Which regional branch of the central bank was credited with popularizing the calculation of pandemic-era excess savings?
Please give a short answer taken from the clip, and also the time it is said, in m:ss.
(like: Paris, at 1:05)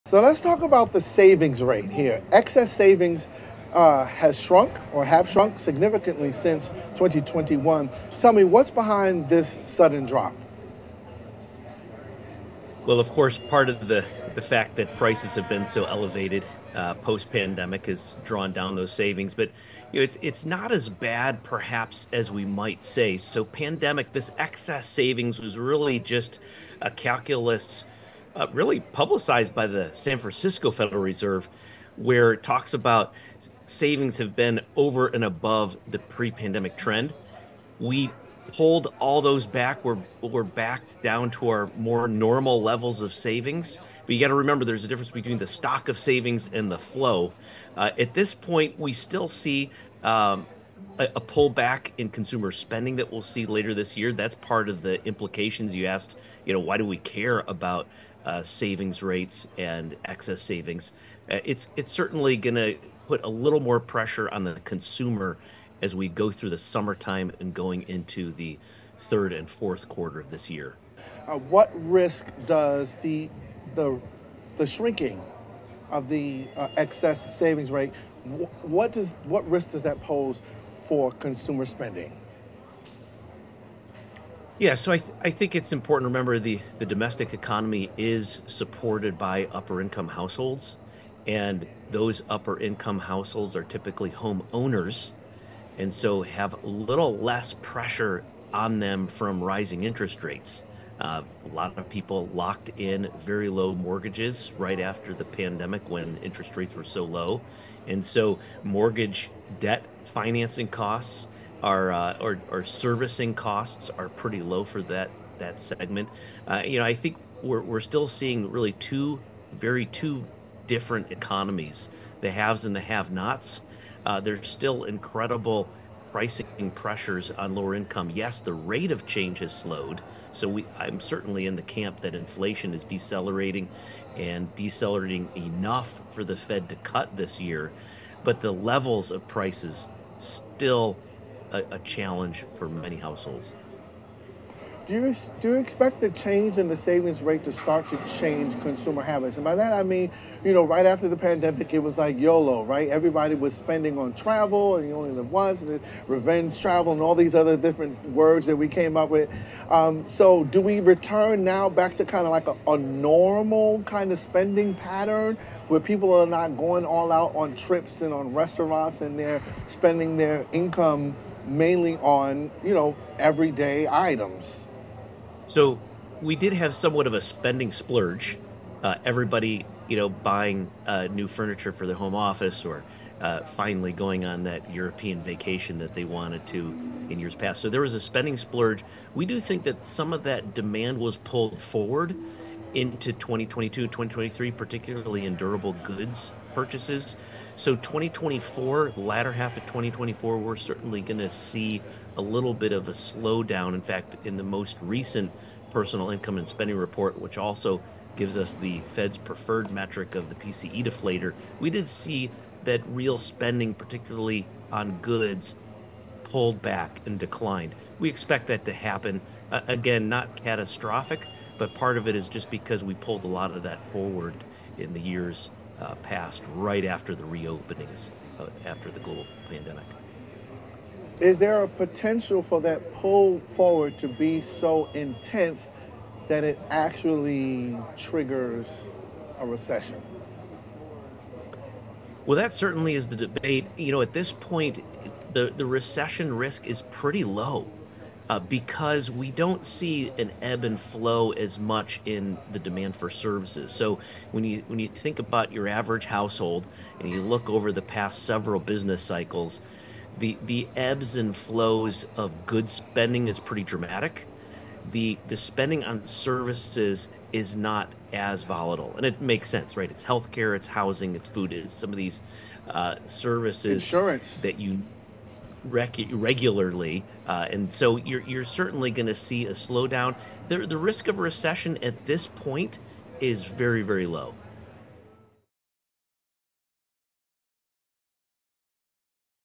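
San Francisco Federal Reserve, at 0:29.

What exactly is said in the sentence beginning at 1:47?
And so mortgage debt financing costs are uh, or, or servicing costs are pretty low for that that segment.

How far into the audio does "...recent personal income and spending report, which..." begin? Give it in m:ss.
3:24.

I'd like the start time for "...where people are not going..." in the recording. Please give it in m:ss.
2:45.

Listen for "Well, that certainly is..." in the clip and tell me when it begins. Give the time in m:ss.
4:02.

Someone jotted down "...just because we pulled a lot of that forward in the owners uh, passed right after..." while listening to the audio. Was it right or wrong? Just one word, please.
wrong.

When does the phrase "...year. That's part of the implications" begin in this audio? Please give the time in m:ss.
0:53.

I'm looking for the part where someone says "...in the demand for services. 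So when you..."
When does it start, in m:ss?
4:12.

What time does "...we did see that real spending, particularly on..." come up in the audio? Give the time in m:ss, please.
3:31.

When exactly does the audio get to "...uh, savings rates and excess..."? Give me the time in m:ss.
0:58.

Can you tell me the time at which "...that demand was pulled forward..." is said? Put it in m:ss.
3:10.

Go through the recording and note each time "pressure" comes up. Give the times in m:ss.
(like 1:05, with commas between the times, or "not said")
1:03, 1:37, 2:06.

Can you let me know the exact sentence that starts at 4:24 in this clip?
The the spending on services is not as volatile, and it makes sense, right?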